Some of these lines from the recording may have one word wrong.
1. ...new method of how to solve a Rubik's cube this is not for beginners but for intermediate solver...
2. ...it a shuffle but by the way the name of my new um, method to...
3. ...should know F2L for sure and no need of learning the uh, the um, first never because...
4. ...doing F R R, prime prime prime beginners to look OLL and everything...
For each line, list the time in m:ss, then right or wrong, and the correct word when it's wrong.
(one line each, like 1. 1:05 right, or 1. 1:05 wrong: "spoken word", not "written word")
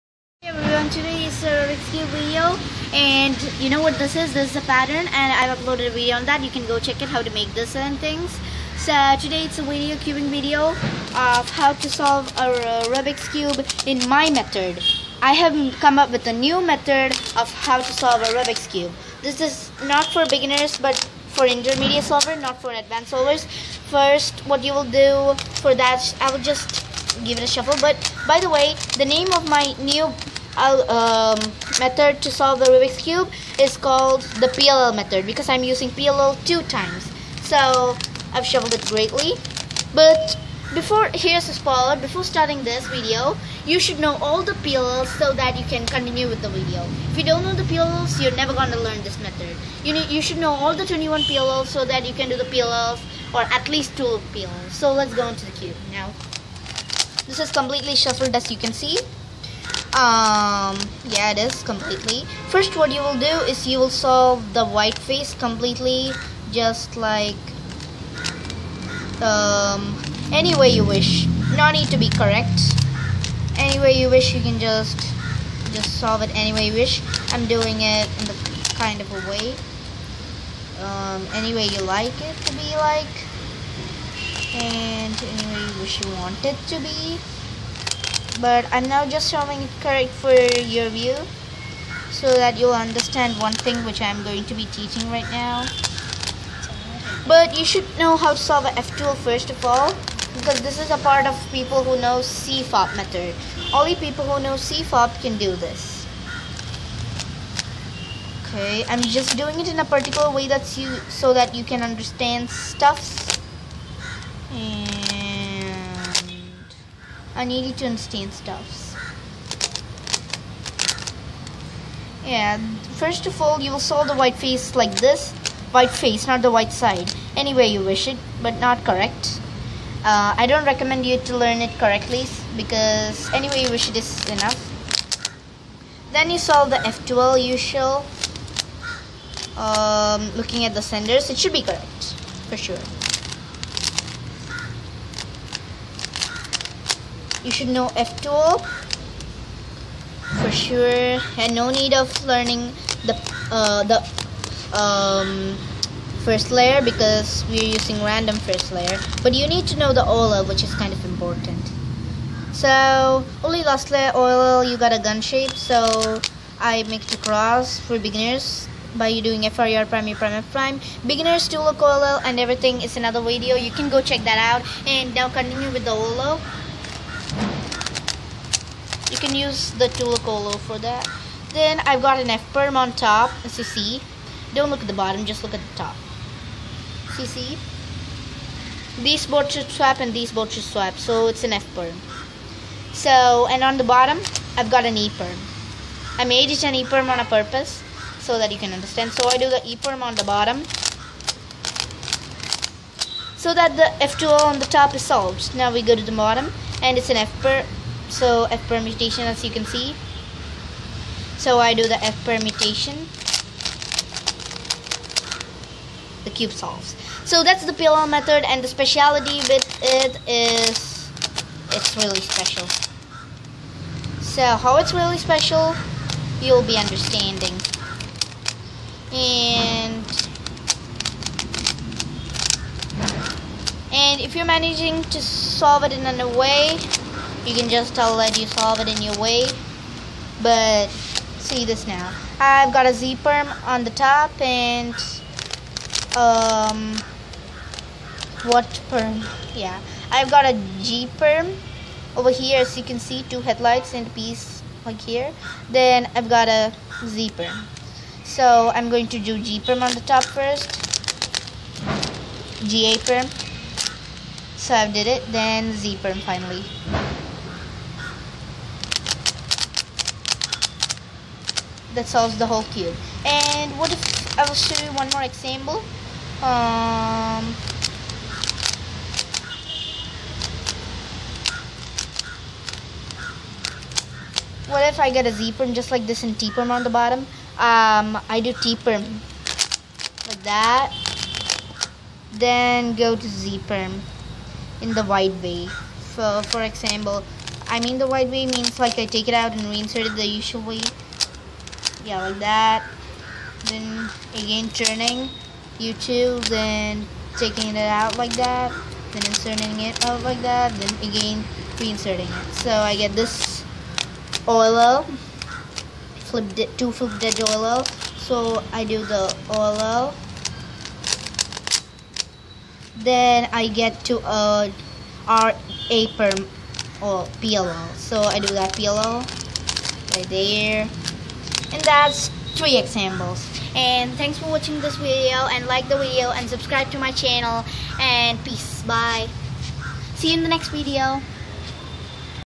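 1. 0:16 right
2. 0:27 right
3. 2:27 wrong: "layer", not "never"
4. 2:49 right.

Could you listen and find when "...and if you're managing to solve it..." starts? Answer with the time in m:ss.
3:53.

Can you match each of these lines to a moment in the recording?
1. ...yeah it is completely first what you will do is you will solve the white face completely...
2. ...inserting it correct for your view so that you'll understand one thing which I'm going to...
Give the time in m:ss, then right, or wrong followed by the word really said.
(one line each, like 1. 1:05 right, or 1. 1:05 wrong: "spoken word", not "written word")
1. 1:01 right
2. 1:29 wrong: "showing", not "inserting".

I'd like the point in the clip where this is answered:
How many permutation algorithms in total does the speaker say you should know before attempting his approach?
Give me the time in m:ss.
0:50.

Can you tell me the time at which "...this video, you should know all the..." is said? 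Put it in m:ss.
0:42.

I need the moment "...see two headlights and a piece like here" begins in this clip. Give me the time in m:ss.
4:12.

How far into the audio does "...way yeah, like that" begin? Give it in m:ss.
5:00.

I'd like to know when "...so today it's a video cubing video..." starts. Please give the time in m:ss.
0:08.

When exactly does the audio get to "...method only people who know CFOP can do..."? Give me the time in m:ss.
1:42.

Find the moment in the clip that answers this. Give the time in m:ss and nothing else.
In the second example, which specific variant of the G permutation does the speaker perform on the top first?
4:22.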